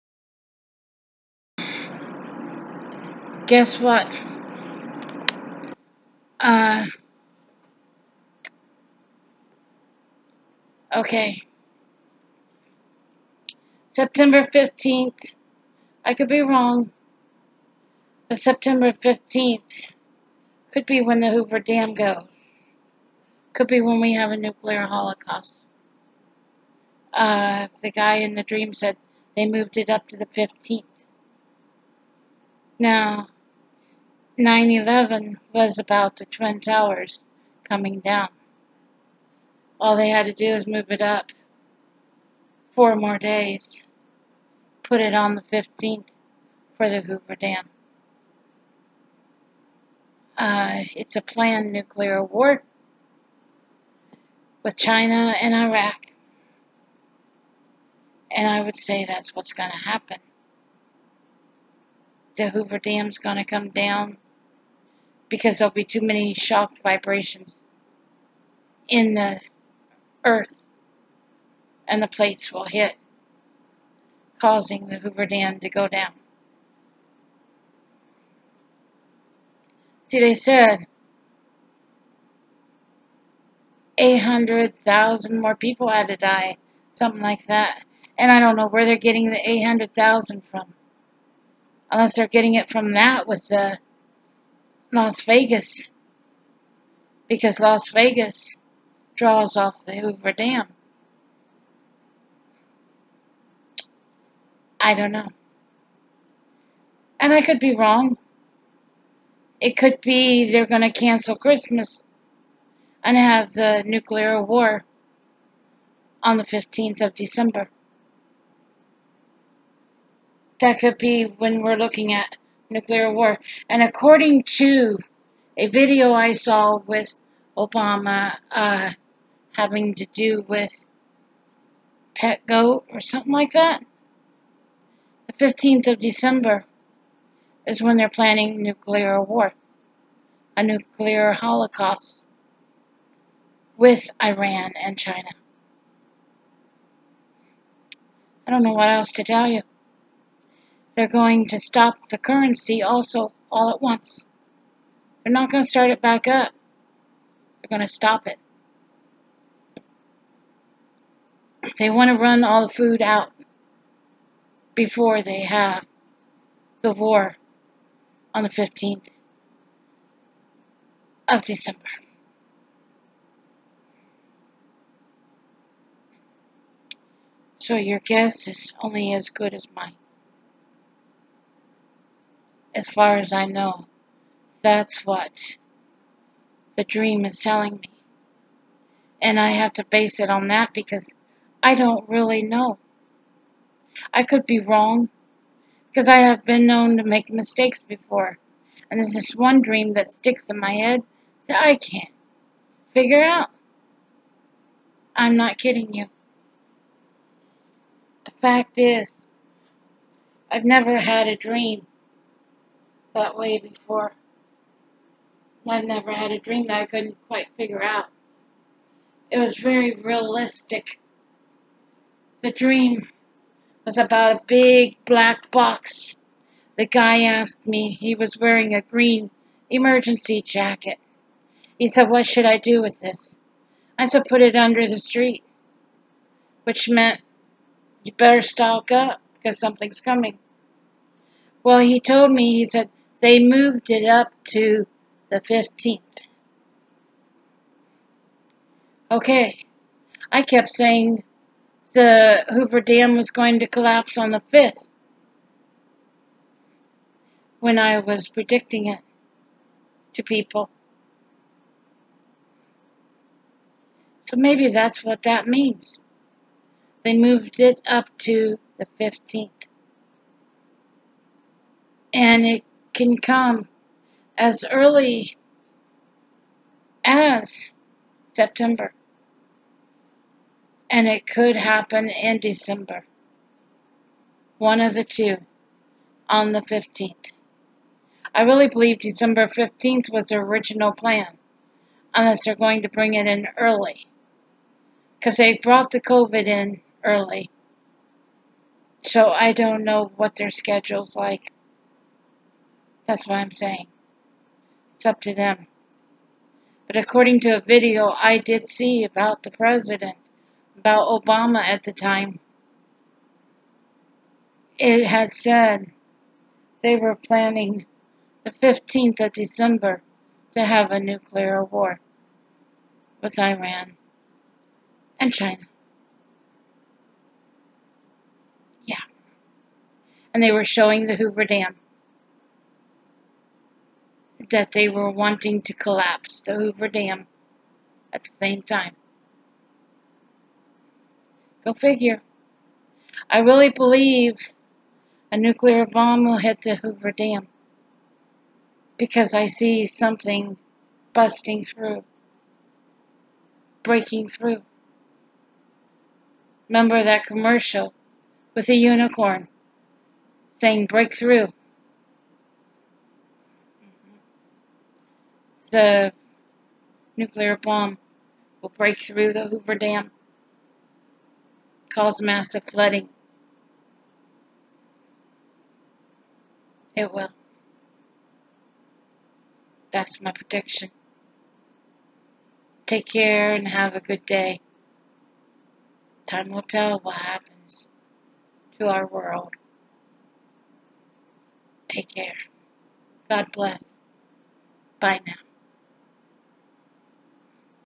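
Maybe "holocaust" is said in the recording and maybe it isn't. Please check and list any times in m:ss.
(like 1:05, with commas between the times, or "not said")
0:24, 2:21.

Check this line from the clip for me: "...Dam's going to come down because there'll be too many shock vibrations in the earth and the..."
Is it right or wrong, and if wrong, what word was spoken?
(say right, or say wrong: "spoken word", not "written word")
right.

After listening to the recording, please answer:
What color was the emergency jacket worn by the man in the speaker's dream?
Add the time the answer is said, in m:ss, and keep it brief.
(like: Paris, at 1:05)
green, at 3:48.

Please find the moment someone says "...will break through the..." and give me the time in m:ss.
6:08.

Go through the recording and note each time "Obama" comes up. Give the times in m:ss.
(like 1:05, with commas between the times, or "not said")
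2:07, 5:11.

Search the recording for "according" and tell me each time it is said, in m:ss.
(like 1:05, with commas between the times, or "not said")
2:03, 5:06.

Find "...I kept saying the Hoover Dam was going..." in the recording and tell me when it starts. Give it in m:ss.
4:10.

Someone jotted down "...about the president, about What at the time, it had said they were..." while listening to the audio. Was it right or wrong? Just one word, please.
wrong.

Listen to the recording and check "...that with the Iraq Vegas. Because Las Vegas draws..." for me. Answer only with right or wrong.
wrong.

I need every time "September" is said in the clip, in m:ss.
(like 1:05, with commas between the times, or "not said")
0:13, 0:18, 4:38.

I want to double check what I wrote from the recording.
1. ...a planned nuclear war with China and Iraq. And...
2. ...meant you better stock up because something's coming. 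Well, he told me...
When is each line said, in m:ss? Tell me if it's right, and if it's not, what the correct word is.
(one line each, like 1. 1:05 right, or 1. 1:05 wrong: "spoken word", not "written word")
1. 0:51 right
2. 3:56 right.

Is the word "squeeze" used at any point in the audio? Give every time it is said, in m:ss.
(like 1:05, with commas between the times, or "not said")
not said.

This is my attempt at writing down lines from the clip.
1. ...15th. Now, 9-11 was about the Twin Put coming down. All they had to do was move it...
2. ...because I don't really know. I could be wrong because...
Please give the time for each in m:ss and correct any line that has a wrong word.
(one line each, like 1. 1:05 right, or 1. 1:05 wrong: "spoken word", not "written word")
1. 0:30 wrong: "Towers", not "Put"
2. 3:10 right.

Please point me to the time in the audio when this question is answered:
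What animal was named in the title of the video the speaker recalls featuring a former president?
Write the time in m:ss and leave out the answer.
2:12.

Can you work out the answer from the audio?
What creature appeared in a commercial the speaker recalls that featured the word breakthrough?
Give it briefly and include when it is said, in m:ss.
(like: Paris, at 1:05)
unicorn, at 5:58.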